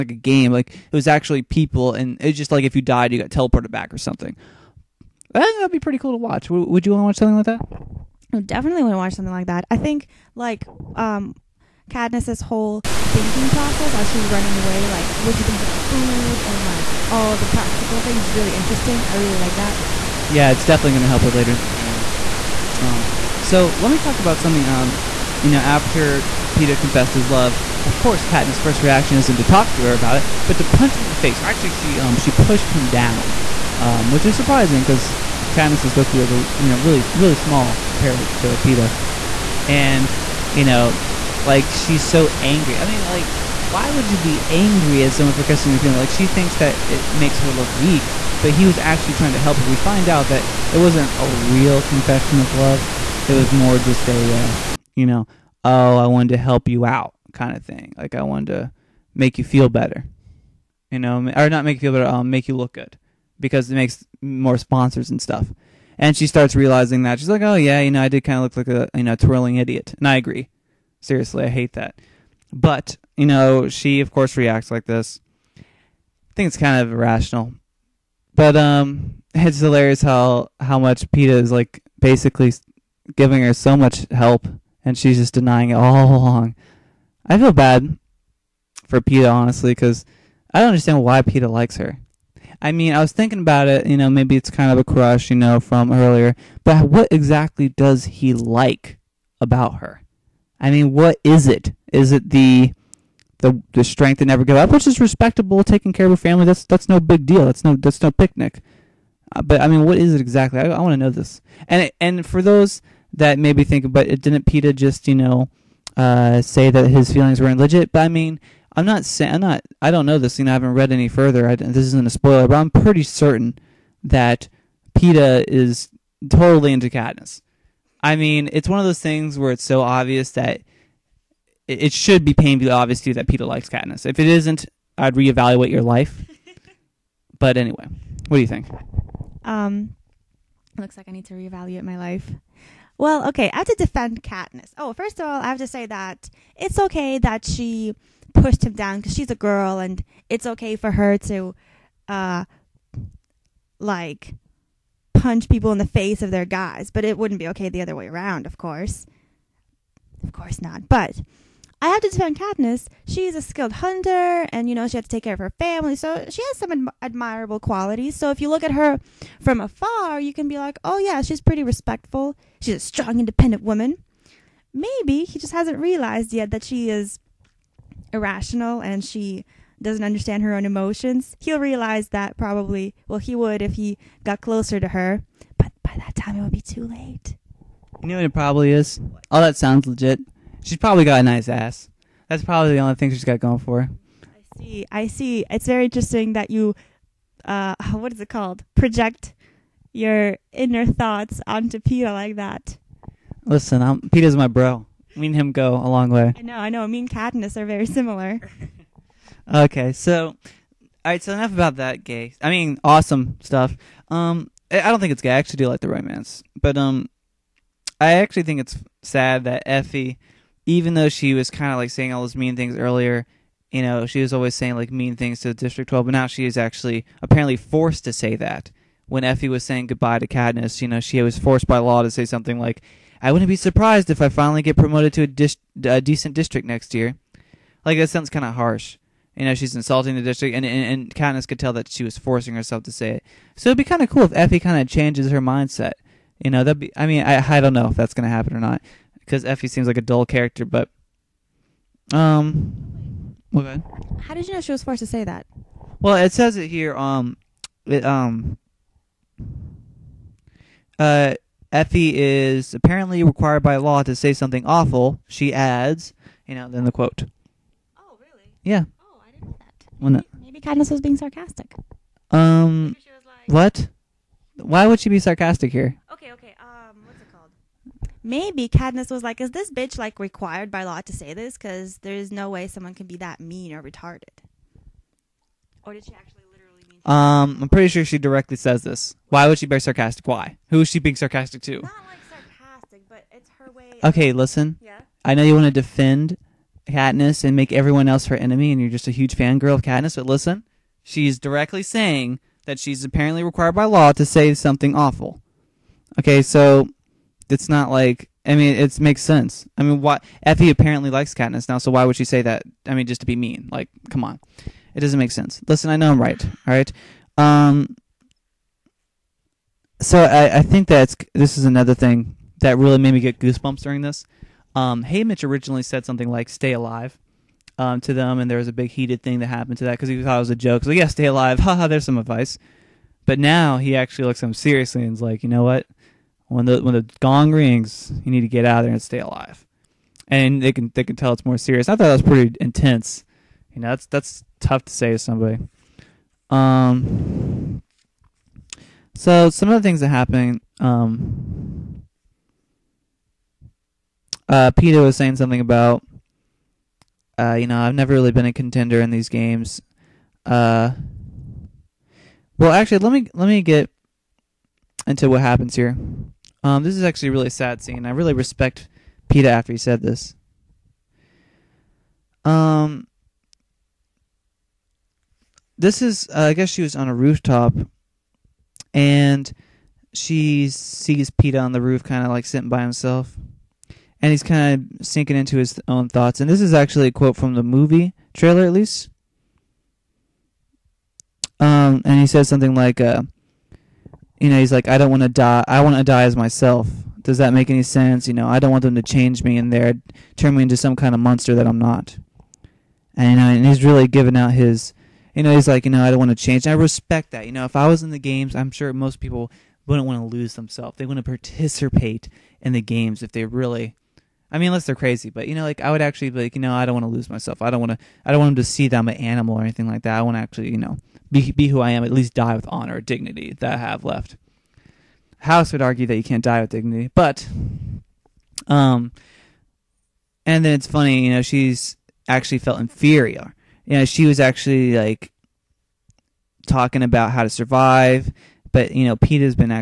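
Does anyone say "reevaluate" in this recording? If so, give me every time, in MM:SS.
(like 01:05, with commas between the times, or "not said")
02:15, 02:21.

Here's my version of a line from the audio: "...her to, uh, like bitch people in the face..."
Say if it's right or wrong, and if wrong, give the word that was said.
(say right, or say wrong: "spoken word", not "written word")
wrong: "punch", not "bitch".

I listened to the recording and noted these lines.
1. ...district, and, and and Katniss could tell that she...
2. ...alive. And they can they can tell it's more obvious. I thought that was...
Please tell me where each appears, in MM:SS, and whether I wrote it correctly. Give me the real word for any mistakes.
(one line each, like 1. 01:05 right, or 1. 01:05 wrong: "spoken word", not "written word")
1. 04:00 right
2. 05:39 wrong: "serious", not "obvious".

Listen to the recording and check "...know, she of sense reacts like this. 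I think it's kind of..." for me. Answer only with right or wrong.
wrong.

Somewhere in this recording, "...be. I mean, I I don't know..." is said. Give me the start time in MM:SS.
04:06.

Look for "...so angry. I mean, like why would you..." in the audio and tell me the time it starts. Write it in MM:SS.
00:42.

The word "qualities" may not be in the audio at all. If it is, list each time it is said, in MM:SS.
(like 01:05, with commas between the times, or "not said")
02:47.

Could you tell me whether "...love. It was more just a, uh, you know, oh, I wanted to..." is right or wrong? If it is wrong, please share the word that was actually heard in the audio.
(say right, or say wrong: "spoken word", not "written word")
right.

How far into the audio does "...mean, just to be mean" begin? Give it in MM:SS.
05:12.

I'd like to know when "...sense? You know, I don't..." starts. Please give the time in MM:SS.
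06:37.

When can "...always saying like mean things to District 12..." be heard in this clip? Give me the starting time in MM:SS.
03:44.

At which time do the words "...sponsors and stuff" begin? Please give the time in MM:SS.
01:04.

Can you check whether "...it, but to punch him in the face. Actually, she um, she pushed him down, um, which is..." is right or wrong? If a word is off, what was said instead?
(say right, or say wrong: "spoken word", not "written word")
right.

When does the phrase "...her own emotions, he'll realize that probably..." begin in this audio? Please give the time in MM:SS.
03:00.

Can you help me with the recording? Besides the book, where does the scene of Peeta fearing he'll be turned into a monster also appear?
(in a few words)
The movie trailer.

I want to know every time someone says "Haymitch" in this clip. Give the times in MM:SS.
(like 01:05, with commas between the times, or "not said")
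05:25.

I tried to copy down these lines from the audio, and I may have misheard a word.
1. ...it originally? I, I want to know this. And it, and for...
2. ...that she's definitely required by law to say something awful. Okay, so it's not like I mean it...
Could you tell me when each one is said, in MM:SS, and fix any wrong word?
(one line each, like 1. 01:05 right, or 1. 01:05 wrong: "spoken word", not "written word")
1. 01:50 wrong: "exactly", not "originally"
2. 05:02 wrong: "apparently", not "definitely".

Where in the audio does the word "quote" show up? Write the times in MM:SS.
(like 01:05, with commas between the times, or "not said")
04:26, 06:27.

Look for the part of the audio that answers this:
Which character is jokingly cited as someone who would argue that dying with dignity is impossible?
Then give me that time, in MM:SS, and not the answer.
07:05.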